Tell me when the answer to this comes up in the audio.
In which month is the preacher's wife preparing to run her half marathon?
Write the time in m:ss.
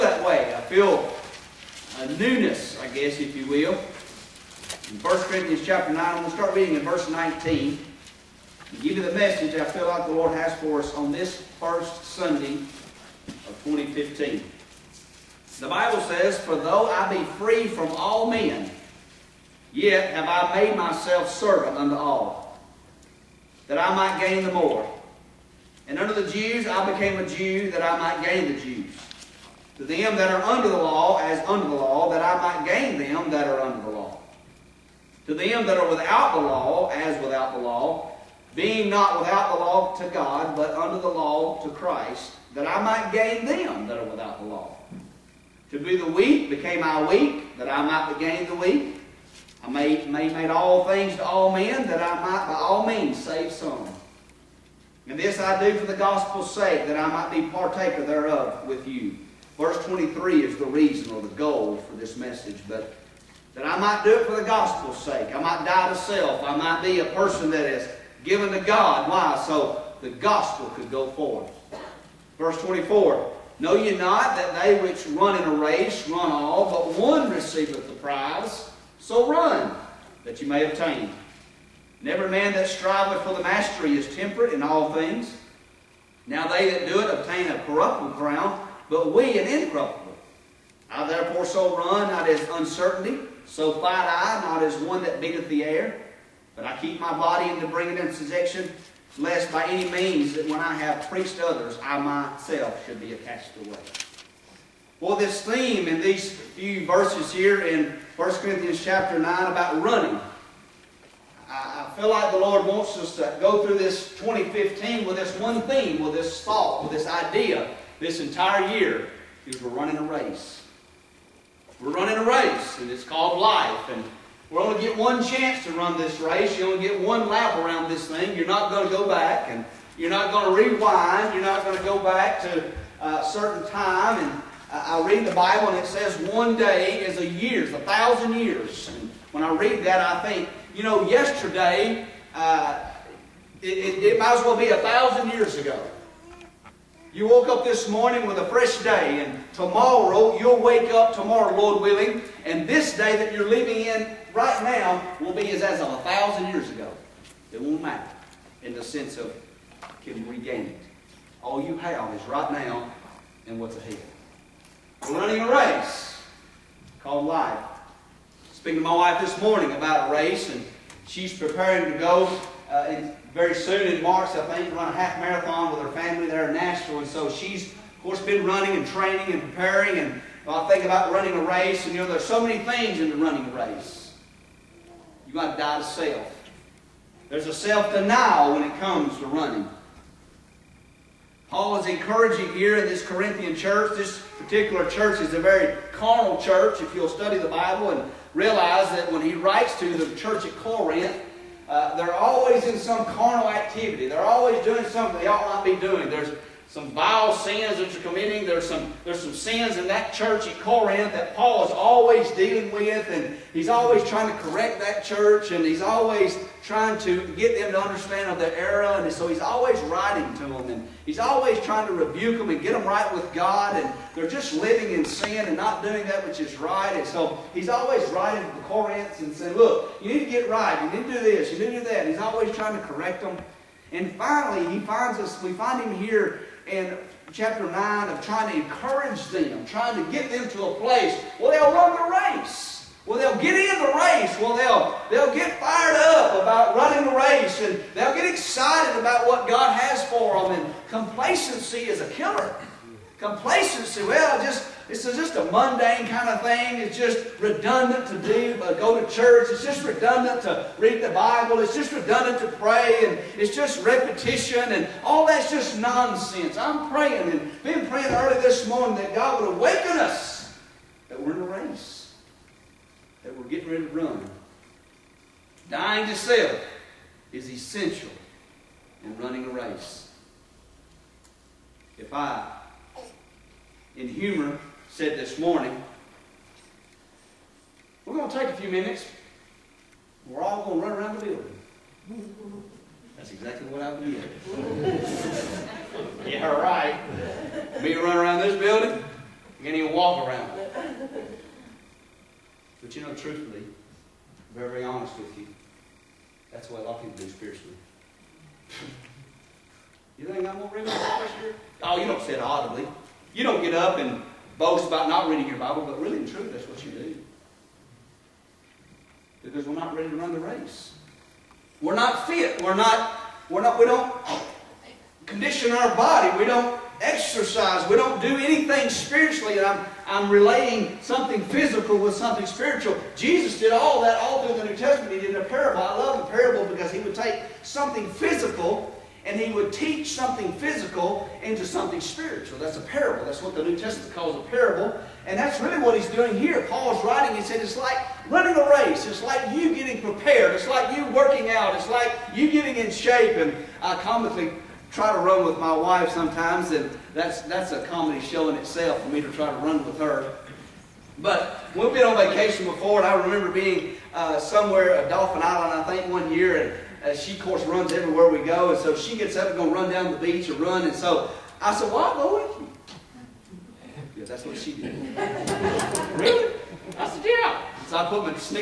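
2:54.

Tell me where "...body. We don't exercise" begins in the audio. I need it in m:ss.
5:25.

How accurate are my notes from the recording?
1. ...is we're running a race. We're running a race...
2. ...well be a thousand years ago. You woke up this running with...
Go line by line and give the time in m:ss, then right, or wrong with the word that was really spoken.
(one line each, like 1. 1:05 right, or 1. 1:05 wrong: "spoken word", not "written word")
1. 1:59 right
2. 2:24 wrong: "morning", not "running".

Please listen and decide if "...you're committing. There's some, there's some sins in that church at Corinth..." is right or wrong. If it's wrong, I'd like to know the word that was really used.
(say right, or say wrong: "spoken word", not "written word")
right.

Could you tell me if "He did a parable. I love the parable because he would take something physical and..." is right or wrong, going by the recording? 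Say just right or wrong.
right.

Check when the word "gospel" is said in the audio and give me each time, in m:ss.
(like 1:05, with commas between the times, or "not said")
0:55, 1:04, 1:10.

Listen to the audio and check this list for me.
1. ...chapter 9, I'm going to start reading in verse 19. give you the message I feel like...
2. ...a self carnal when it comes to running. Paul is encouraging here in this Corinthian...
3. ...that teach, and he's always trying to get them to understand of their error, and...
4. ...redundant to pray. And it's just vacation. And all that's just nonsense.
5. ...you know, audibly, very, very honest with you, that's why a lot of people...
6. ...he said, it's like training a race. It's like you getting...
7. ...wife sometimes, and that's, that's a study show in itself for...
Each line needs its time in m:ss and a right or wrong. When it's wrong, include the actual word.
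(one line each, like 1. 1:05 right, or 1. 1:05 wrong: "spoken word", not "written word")
1. 0:05 right
2. 3:07 wrong: "denial", not "carnal"
3. 3:34 wrong: "church", not "teach"
4. 4:21 wrong: "repetition", not "vacation"
5. 5:02 wrong: "truthfully", not "audibly"
6. 5:47 wrong: "running", not "training"
7. 5:55 wrong: "comedy", not "study".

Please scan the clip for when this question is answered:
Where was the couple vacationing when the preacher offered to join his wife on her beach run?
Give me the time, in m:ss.
6:05.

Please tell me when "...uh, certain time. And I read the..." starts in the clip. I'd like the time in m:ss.
2:13.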